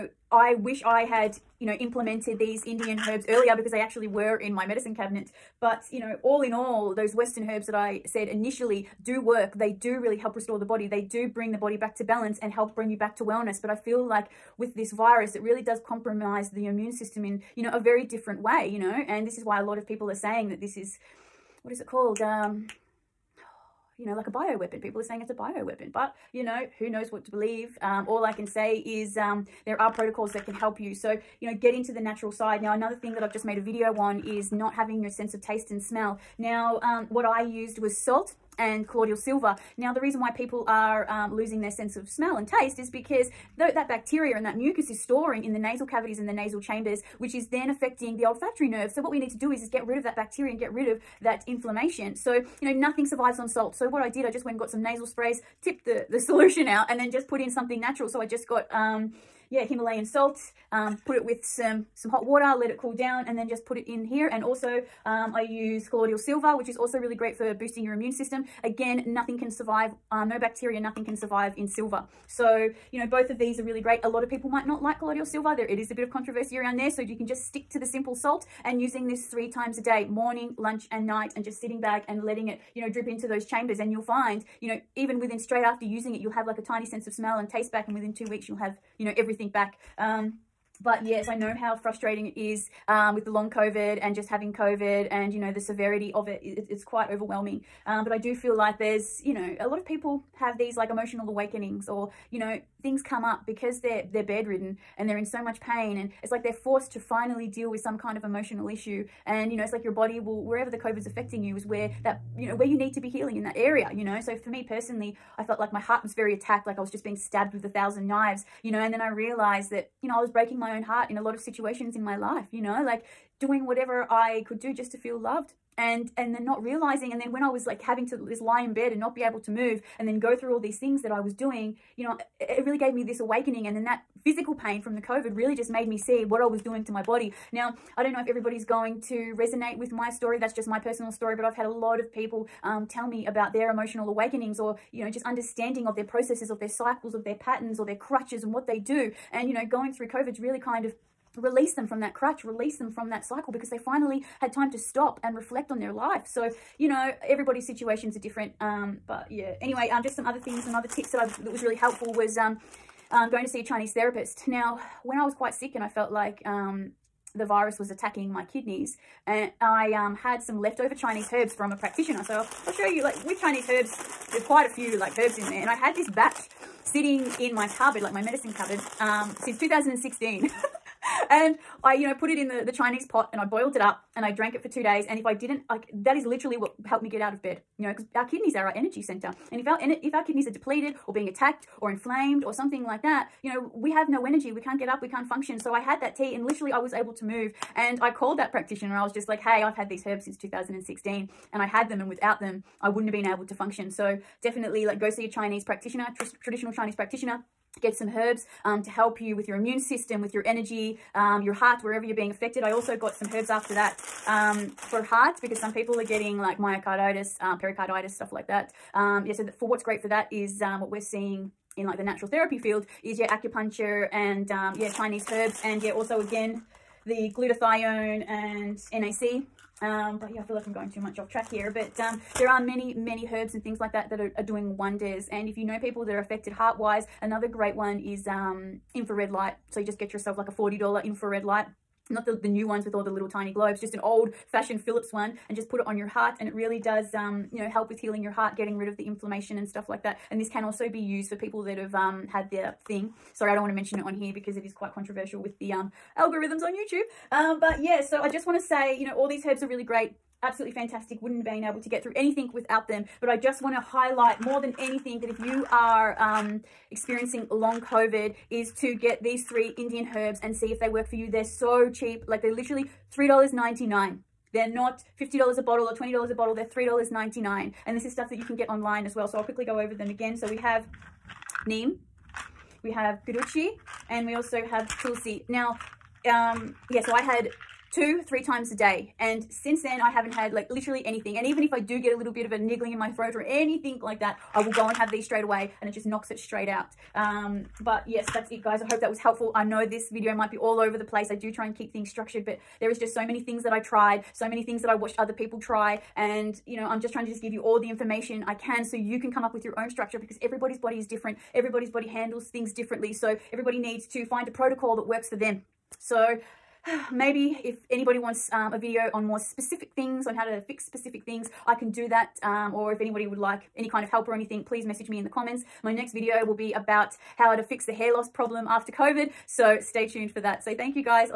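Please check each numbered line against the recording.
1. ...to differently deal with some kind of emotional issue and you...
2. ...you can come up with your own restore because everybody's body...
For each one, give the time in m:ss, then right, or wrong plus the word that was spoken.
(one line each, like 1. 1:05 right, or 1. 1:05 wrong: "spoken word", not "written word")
1. 1:46 wrong: "finally", not "differently"
2. 5:09 wrong: "structure", not "restore".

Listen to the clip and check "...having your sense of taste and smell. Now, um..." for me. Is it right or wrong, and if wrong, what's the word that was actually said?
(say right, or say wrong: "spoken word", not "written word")
right.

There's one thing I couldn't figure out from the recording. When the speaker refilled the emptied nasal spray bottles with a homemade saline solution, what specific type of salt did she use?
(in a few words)
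Himalayan salt.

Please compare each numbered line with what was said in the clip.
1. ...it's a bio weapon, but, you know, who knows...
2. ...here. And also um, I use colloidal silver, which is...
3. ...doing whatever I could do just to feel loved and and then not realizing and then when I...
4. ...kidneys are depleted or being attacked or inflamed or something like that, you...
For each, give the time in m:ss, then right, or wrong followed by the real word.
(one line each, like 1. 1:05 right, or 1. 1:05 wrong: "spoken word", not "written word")
1. 0:25 right
2. 1:04 right
3. 2:03 right
4. 3:10 right.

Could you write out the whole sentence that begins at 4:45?
Now, um, yeah, so I had two, three times a day and since then, I haven't had like literally anything.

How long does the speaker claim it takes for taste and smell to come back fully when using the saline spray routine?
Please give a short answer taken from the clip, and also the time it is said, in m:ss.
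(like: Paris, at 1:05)
2 weeks, at 1:28.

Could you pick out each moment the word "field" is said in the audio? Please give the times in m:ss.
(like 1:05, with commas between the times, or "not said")
3:42.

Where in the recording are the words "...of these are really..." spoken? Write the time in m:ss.
1:13.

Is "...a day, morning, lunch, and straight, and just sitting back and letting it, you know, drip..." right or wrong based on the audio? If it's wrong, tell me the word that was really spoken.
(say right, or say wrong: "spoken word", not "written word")
wrong: "night", not "straight".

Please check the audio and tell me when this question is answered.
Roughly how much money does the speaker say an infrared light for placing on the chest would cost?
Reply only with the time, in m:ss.
4:00.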